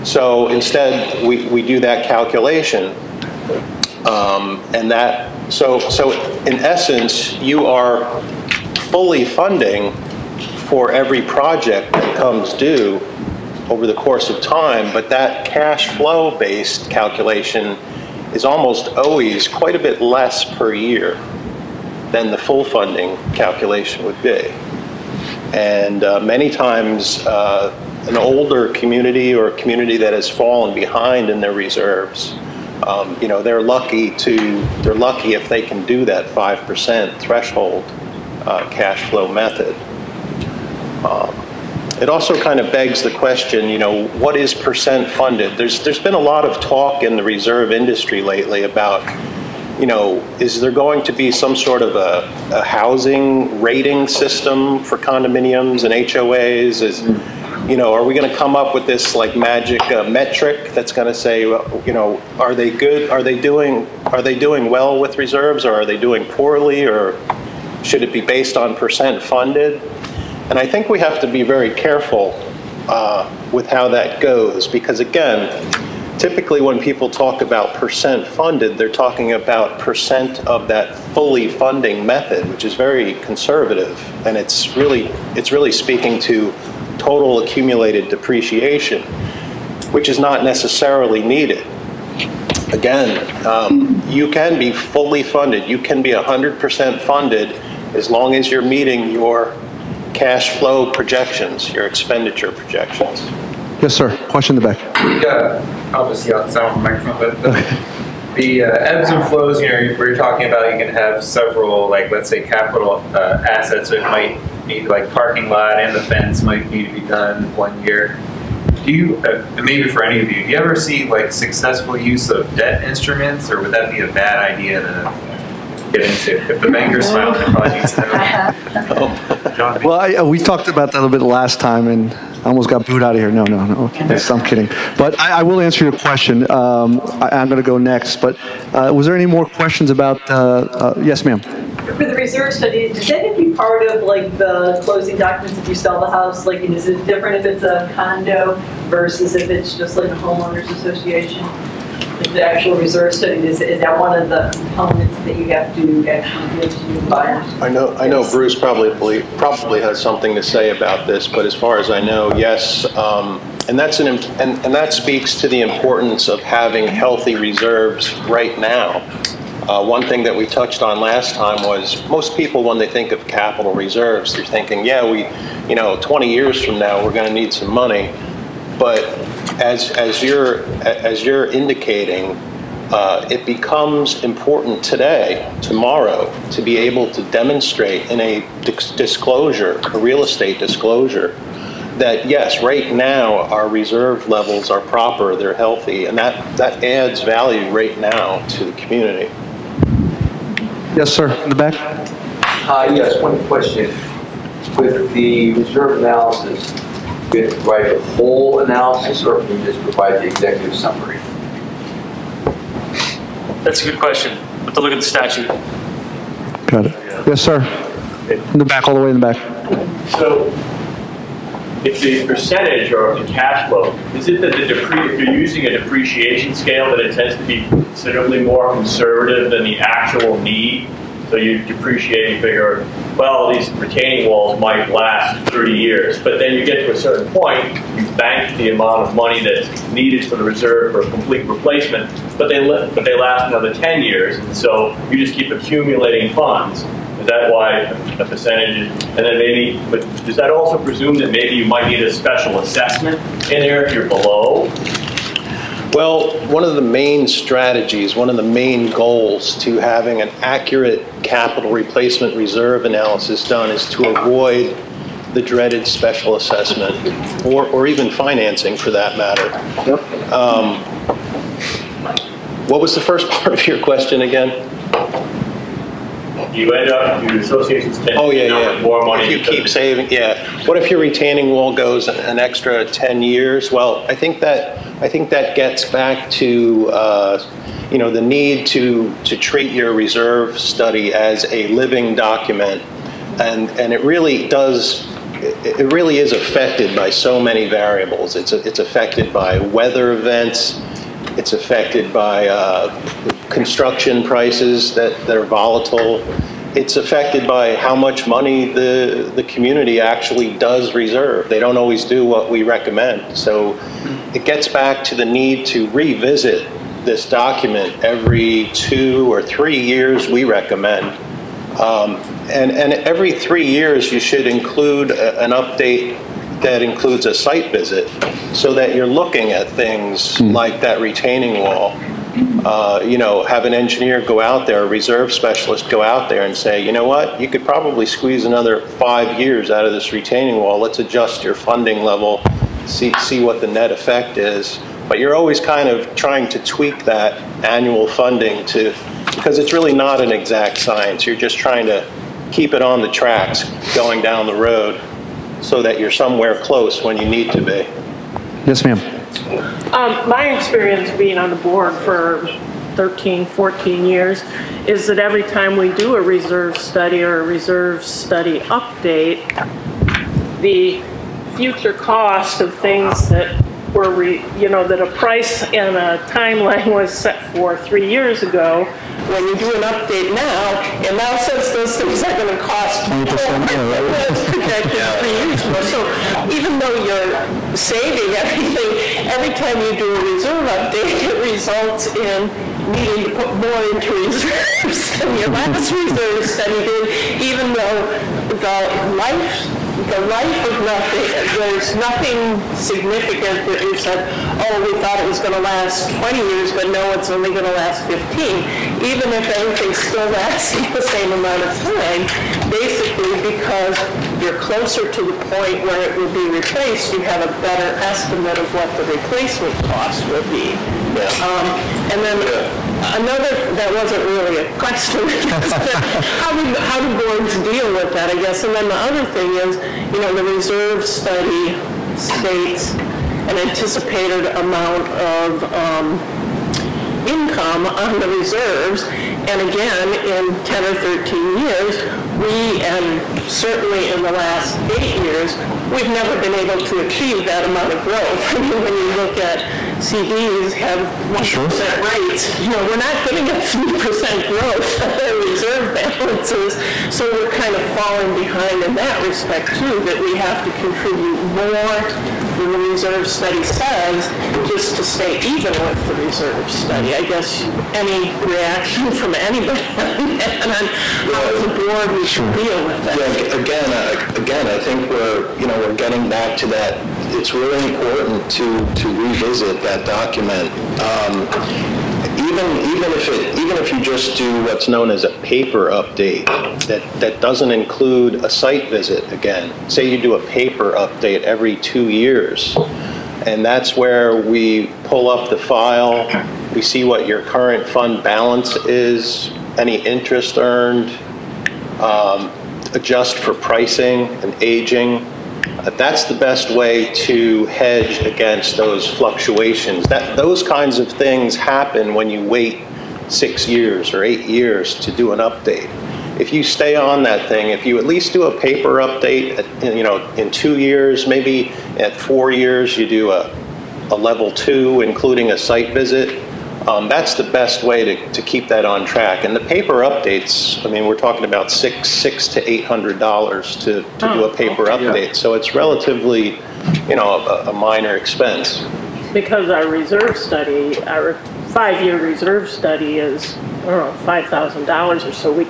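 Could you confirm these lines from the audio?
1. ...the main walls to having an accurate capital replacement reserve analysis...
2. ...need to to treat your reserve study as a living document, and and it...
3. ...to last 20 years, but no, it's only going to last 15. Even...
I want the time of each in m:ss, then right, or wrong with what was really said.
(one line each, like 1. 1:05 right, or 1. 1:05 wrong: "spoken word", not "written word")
1. 4:18 wrong: "goals", not "walls"
2. 4:48 right
3. 6:45 right.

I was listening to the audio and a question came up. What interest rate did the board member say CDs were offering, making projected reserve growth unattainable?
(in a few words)
1%.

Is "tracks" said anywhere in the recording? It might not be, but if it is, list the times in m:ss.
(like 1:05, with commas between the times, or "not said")
5:53, 8:49.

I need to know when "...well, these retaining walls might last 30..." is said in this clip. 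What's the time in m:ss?
3:53.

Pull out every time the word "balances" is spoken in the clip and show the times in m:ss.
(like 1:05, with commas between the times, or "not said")
7:35, 8:18.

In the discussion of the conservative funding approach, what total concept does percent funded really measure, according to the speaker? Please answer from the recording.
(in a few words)
total accumulated depreciation.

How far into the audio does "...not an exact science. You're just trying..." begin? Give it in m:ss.
5:49.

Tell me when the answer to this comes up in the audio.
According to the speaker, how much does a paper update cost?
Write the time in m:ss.
8:51.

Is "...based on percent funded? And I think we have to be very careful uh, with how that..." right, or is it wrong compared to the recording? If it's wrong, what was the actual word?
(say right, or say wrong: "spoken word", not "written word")
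right.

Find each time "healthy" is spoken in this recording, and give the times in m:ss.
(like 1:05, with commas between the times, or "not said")
2:46, 3:15.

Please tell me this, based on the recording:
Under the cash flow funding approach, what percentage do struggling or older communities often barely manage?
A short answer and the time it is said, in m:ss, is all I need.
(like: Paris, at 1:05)
5%, at 0:36.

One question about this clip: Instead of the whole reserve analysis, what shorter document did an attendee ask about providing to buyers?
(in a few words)
executive summary.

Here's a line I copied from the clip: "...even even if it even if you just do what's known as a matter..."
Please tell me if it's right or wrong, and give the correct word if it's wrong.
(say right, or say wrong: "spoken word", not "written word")
wrong: "paper", not "matter".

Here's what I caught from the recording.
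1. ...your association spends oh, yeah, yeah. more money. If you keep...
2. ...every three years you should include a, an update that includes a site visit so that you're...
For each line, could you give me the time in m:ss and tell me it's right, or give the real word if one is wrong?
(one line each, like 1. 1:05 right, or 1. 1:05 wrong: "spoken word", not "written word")
1. 4:37 right
2. 5:22 right.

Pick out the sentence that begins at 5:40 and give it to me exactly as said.
Let's adjust your funding level, see, see what the net effect is.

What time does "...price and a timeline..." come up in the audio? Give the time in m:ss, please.
6:15.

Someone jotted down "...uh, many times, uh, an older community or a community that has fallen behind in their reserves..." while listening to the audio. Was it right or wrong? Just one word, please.
right.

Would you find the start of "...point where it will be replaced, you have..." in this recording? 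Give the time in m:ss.
6:55.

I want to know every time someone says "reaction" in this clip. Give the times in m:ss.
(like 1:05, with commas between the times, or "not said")
7:48.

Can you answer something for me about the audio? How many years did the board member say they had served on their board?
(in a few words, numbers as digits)
13 or 14 years.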